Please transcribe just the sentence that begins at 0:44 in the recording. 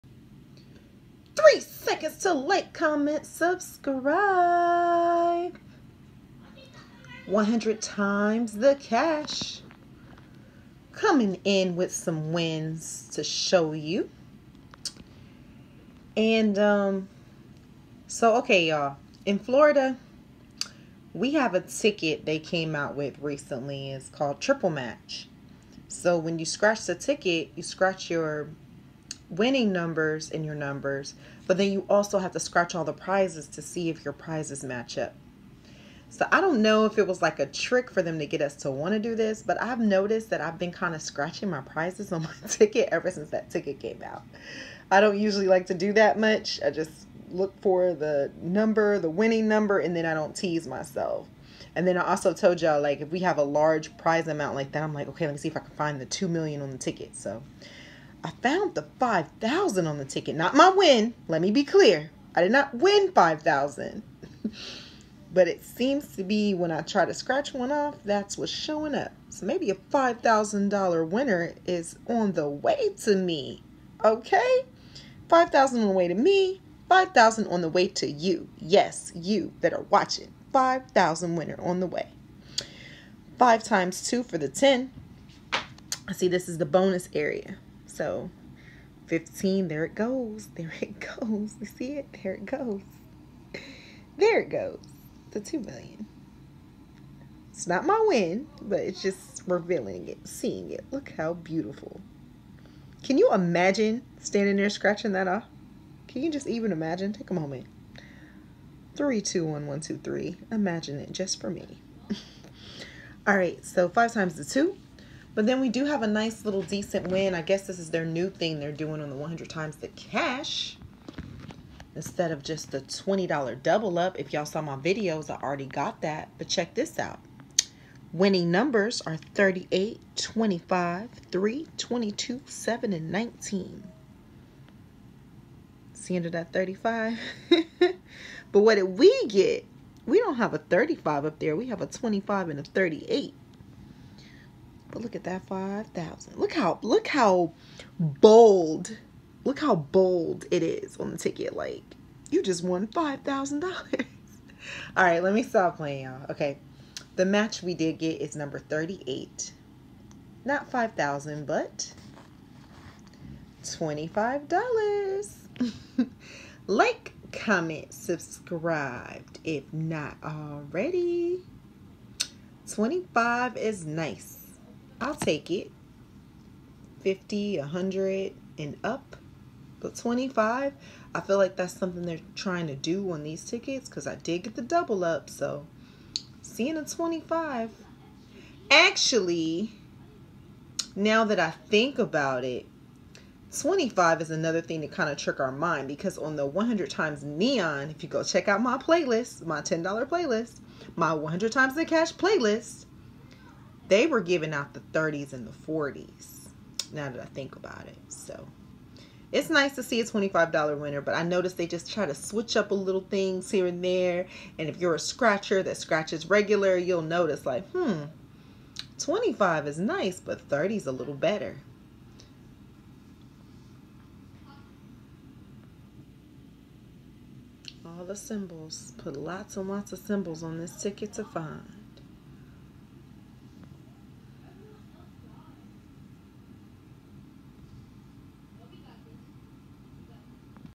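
I don't usually like to do that much.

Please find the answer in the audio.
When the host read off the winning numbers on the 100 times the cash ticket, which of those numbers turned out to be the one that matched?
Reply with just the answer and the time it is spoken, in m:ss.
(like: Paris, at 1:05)
38, at 2:38.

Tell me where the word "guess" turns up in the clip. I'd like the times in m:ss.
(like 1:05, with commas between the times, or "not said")
1:57.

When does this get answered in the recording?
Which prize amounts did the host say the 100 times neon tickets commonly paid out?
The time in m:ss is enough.
3:24.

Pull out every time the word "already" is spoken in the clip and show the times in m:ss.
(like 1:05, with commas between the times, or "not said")
2:05, 2:50.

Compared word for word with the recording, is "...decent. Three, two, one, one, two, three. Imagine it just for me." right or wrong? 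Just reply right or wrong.
wrong.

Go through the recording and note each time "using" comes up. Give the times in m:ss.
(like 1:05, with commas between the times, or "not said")
not said.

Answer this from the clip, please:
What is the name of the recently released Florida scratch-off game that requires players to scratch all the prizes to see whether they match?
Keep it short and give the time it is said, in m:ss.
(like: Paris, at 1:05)
Triple Match, at 0:24.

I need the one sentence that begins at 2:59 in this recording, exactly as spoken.
But 25, I feel like that's something they're trying to do on these tickets because I did get the double up.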